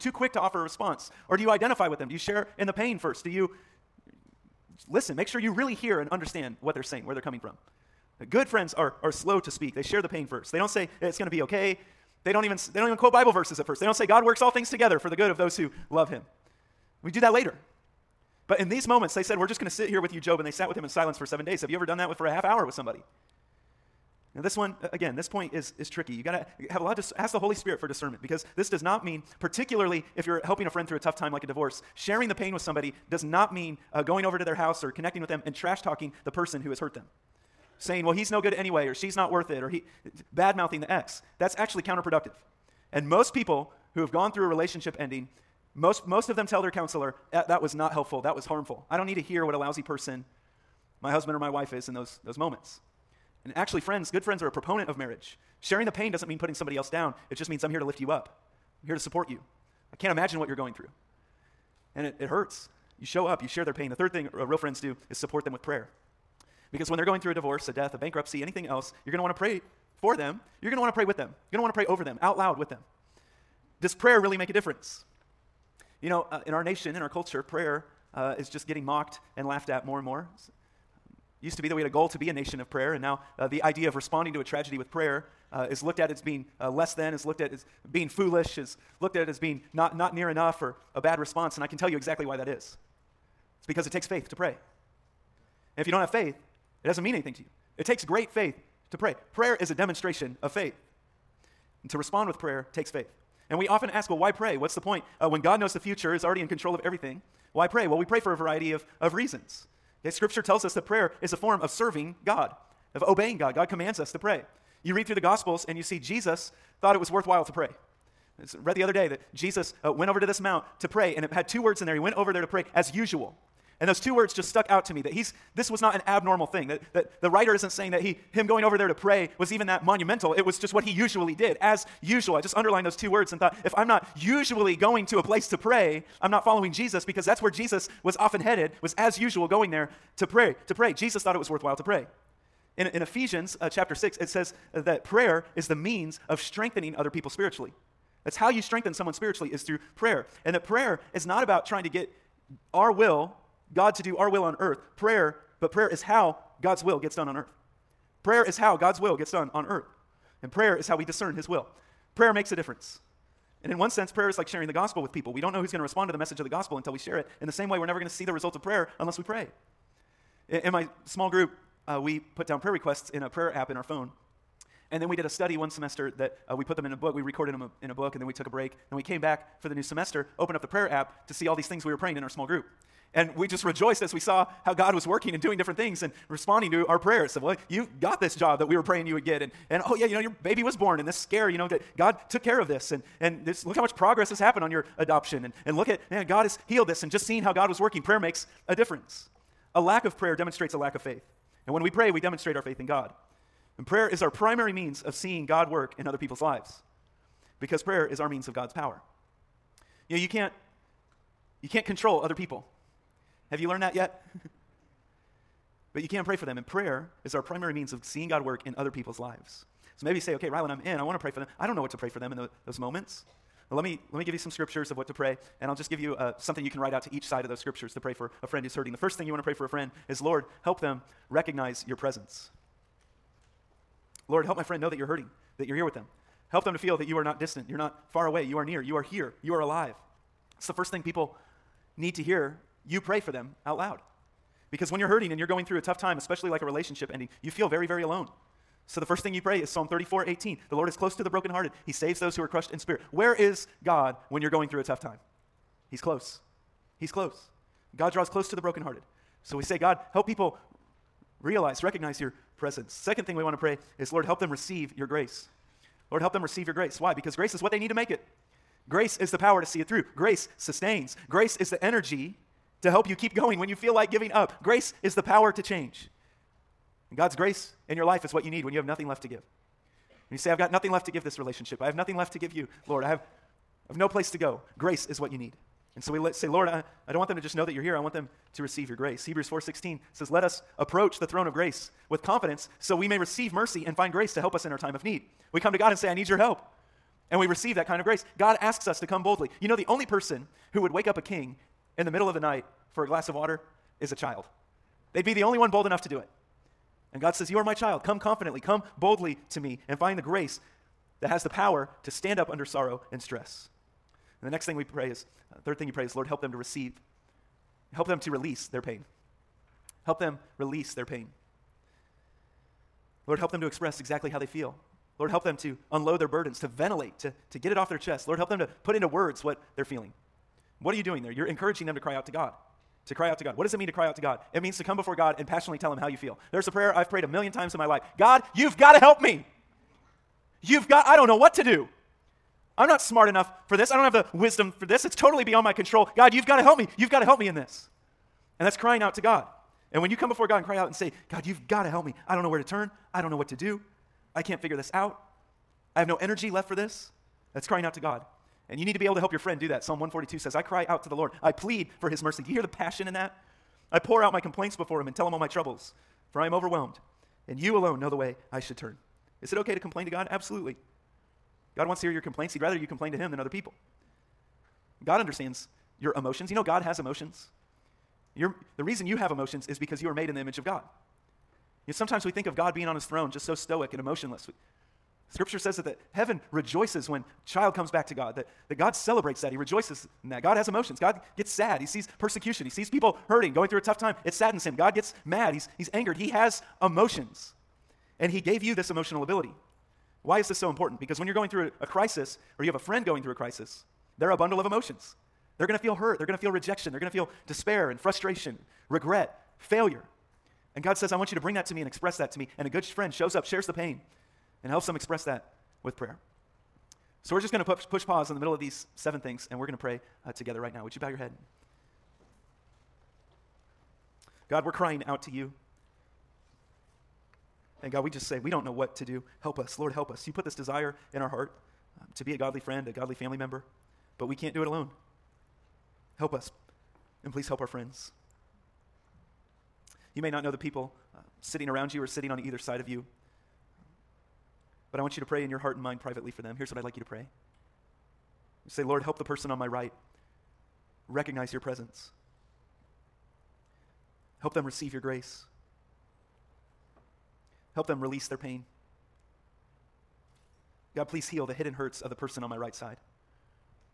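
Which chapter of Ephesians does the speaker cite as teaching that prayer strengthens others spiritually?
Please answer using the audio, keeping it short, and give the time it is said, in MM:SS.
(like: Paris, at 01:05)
Chapter 6, at 02:23.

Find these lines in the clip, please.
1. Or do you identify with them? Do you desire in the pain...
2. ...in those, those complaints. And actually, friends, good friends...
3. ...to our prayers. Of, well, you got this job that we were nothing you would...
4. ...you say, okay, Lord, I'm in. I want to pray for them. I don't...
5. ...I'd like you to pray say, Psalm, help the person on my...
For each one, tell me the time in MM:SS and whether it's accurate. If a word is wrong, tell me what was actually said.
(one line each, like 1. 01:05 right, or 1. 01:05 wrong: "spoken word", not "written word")
1. 00:01 wrong: "share", not "desire"
2. 00:51 wrong: "moments", not "complaints"
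3. 03:06 wrong: "praying", not "nothing"
4. 03:40 wrong: "Ryland", not "Lord"
5. 07:26 wrong: "Lord", not "Psalm".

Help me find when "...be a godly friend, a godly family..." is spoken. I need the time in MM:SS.
07:12.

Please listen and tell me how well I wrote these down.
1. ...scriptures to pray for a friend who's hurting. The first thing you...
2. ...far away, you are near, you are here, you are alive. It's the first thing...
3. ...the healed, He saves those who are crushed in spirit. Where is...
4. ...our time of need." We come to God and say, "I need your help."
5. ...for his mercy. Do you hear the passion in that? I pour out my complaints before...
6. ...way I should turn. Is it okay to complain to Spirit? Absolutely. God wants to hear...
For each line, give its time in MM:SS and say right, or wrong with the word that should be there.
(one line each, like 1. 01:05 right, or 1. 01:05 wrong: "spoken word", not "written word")
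1. 03:47 right
2. 03:58 right
3. 04:11 wrong: "brokenhearted", not "healed"
4. 04:54 right
5. 06:01 right
6. 06:08 wrong: "God", not "Spirit".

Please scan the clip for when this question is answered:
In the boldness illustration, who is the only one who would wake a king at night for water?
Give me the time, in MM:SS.
05:04.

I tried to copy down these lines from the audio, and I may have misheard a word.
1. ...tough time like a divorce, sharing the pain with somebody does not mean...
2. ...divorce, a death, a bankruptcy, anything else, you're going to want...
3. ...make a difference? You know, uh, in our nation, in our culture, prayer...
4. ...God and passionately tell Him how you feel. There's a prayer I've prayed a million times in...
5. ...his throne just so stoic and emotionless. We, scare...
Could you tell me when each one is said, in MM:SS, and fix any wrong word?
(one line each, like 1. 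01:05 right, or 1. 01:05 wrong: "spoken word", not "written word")
1. 00:30 right
2. 01:07 right
3. 01:14 right
4. 05:35 right
5. 06:22 wrong: "scripture", not "scare".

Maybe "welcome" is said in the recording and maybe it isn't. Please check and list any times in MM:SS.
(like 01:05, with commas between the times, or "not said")
not said.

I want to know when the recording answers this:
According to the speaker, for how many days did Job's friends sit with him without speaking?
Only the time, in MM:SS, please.
00:21.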